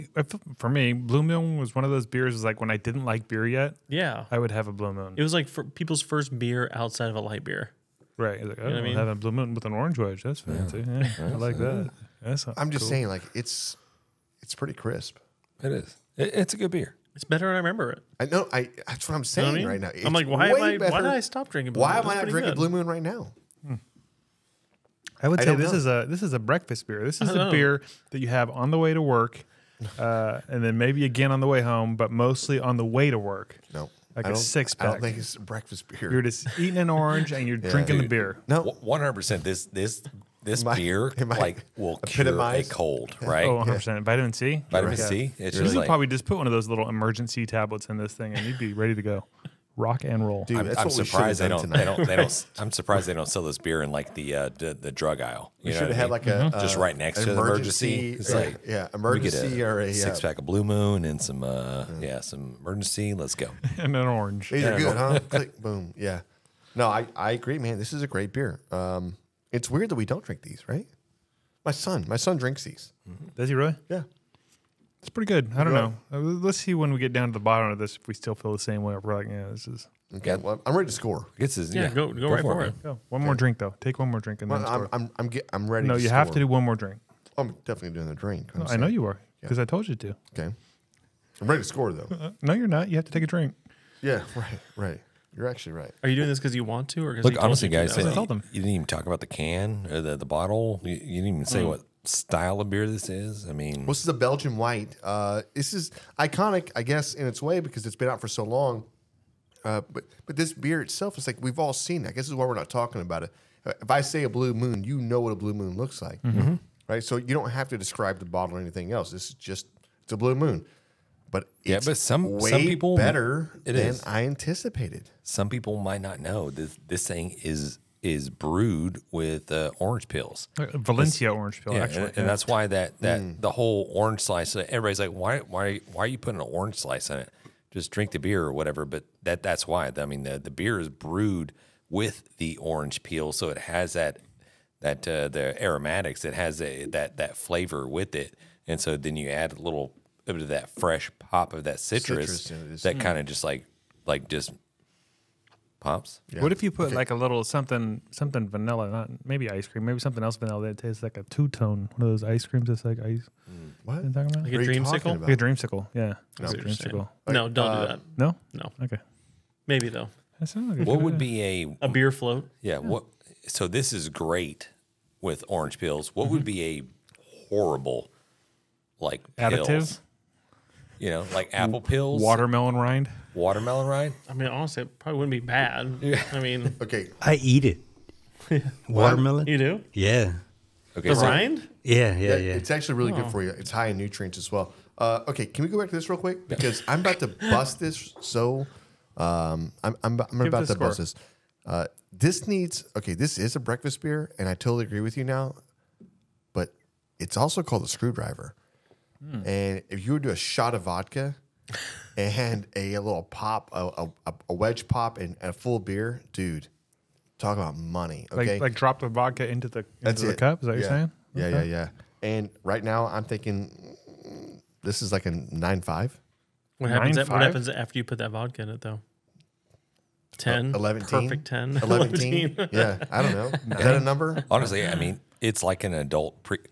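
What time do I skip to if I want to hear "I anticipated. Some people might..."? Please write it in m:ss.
2:04.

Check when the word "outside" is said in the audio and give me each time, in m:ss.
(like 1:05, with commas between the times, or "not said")
0:06.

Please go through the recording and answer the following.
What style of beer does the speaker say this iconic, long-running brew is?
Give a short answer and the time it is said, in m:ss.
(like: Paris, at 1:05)
Belgian white, at 1:44.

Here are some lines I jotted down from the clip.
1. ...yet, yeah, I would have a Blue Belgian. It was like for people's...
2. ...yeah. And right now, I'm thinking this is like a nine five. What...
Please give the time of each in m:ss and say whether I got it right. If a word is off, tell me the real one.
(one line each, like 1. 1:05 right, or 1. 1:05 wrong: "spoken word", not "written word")
1. 0:03 wrong: "Moon", not "Belgian"
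2. 3:41 right.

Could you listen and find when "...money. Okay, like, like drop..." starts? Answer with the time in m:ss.
3:37.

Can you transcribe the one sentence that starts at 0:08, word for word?
having a Blue Moon with an orange wedge.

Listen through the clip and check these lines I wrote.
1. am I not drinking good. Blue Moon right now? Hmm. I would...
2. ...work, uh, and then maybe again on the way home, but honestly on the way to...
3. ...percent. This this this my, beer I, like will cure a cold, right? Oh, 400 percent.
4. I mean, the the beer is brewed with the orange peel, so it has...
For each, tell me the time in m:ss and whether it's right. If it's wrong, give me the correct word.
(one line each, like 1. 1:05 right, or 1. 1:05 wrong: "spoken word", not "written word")
1. 0:22 right
2. 0:29 wrong: "mostly", not "honestly"
3. 0:39 wrong: "100", not "400"
4. 2:19 right.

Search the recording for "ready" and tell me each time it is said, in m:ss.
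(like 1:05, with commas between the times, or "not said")
0:48, 1:20, 1:25, 1:31.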